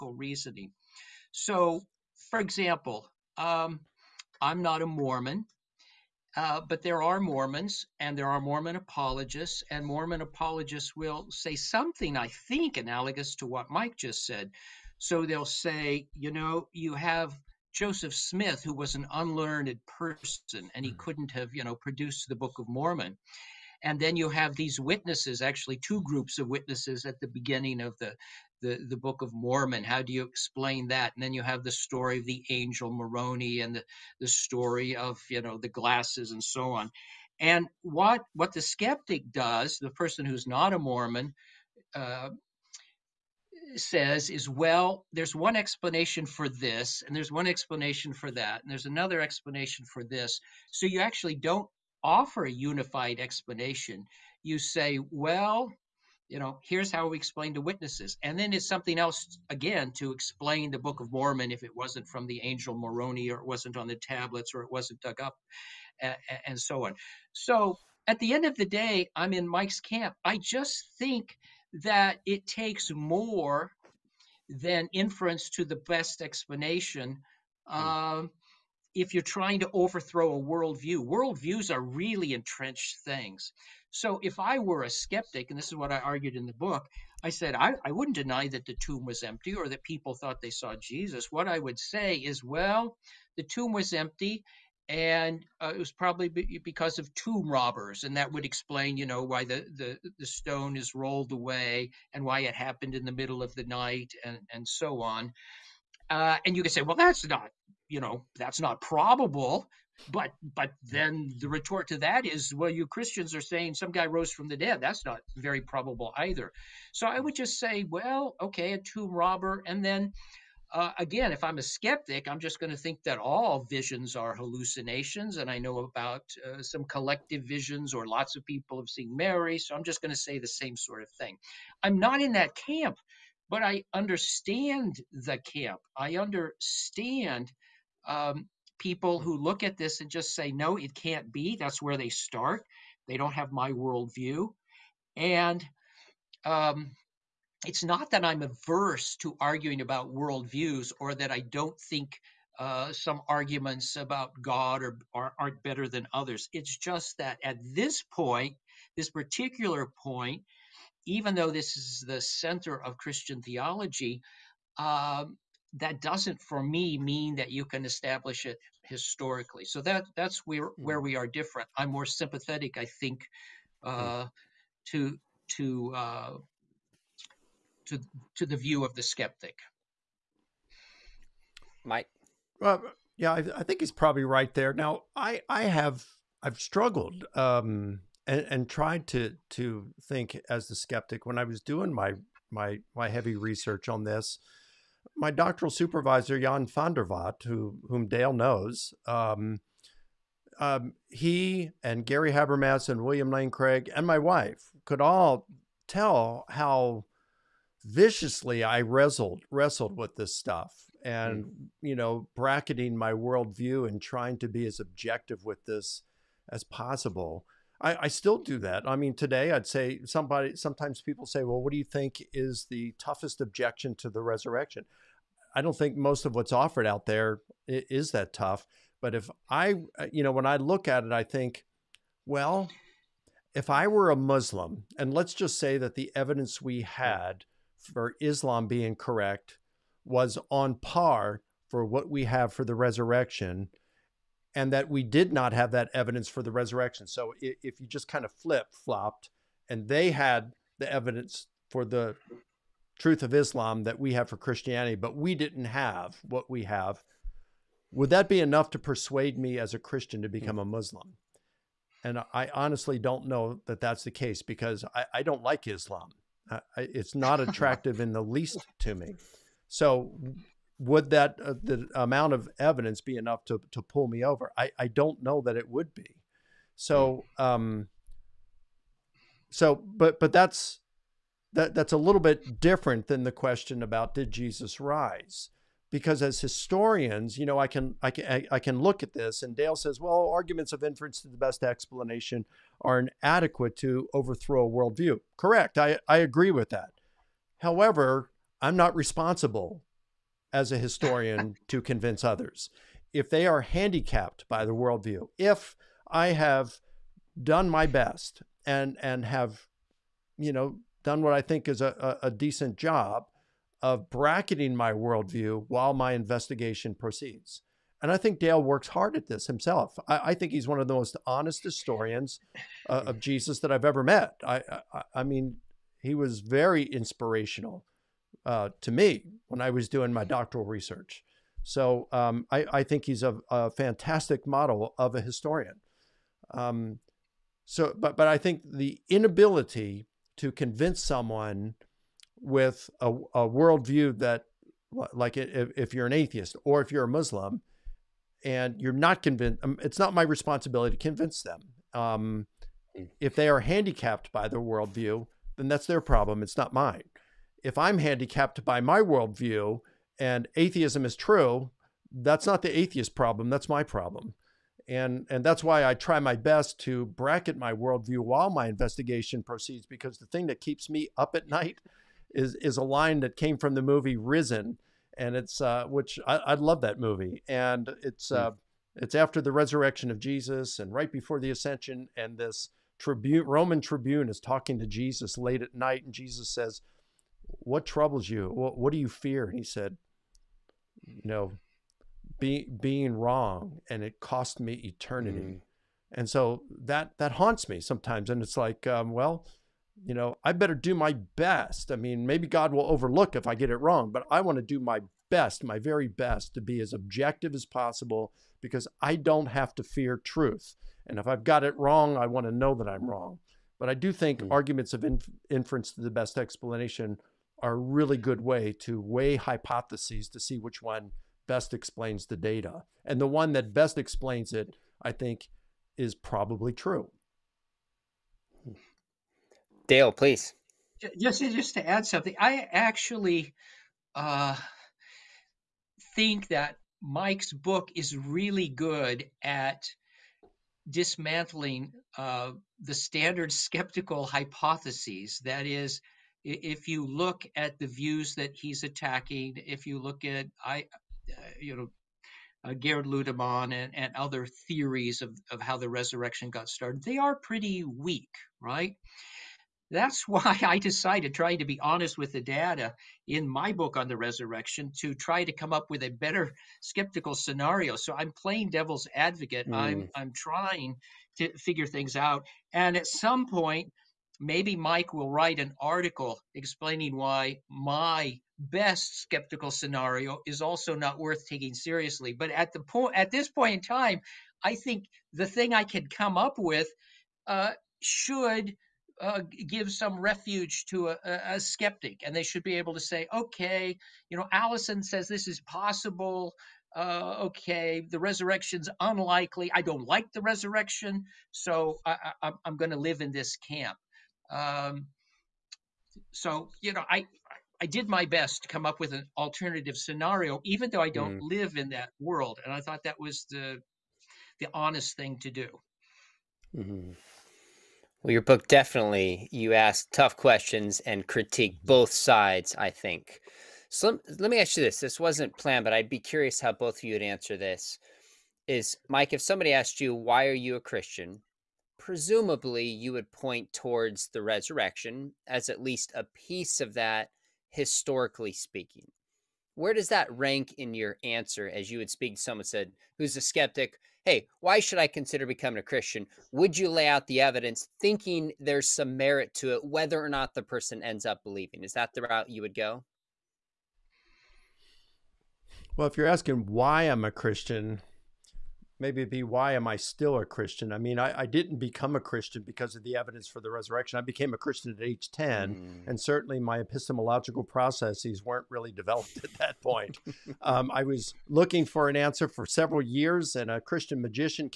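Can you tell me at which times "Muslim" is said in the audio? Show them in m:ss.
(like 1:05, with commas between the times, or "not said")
3:54, 4:20, 5:47.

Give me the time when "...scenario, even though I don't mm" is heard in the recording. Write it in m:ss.
8:29.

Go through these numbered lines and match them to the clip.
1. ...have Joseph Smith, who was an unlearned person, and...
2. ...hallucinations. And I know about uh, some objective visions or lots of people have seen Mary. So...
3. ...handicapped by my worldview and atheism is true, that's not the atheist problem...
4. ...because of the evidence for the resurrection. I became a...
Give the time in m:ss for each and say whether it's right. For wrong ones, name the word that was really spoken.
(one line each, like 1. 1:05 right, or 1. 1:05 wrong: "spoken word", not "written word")
1. 0:16 right
2. 2:04 wrong: "collective", not "objective"
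3. 5:57 right
4. 9:22 right.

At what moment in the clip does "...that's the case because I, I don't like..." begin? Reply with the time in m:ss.
4:23.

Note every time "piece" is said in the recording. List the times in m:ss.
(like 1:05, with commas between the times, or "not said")
8:56.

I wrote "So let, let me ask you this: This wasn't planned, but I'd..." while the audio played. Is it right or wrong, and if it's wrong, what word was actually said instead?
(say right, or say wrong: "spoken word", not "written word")
right.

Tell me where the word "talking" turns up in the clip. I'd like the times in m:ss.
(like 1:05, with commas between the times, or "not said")
6:24.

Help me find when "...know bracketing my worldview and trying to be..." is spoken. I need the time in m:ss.
3:31.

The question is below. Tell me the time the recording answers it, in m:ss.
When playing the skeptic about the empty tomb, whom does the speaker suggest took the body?
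1:37.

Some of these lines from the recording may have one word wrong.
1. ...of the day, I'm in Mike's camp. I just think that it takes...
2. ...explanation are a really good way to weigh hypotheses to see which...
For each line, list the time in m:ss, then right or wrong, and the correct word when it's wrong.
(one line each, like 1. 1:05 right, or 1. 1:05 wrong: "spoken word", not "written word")
1. 1:08 right
2. 6:56 right.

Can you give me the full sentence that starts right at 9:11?
Is that the route you would go?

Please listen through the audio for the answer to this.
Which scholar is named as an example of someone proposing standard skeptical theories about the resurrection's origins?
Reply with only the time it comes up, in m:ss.
7:32.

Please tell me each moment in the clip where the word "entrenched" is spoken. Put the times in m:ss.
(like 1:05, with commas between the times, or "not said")
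1:22.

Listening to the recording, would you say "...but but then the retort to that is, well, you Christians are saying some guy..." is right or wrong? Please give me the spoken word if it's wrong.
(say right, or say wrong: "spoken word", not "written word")
right.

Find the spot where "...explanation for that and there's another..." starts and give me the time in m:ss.
0:47.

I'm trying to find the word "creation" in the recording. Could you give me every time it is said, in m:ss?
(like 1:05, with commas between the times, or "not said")
not said.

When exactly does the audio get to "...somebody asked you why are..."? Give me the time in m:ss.
8:49.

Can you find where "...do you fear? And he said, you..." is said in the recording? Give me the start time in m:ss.
6:28.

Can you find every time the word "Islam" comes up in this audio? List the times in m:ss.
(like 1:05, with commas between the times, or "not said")
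3:58, 4:13, 4:25.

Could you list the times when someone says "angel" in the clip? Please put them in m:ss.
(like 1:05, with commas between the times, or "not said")
0:32, 1:02.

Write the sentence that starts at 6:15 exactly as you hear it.
And it's, uh, which I, I love that movie.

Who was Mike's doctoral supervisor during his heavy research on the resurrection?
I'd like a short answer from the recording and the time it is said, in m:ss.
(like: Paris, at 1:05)
Jan van der Watt, at 3:16.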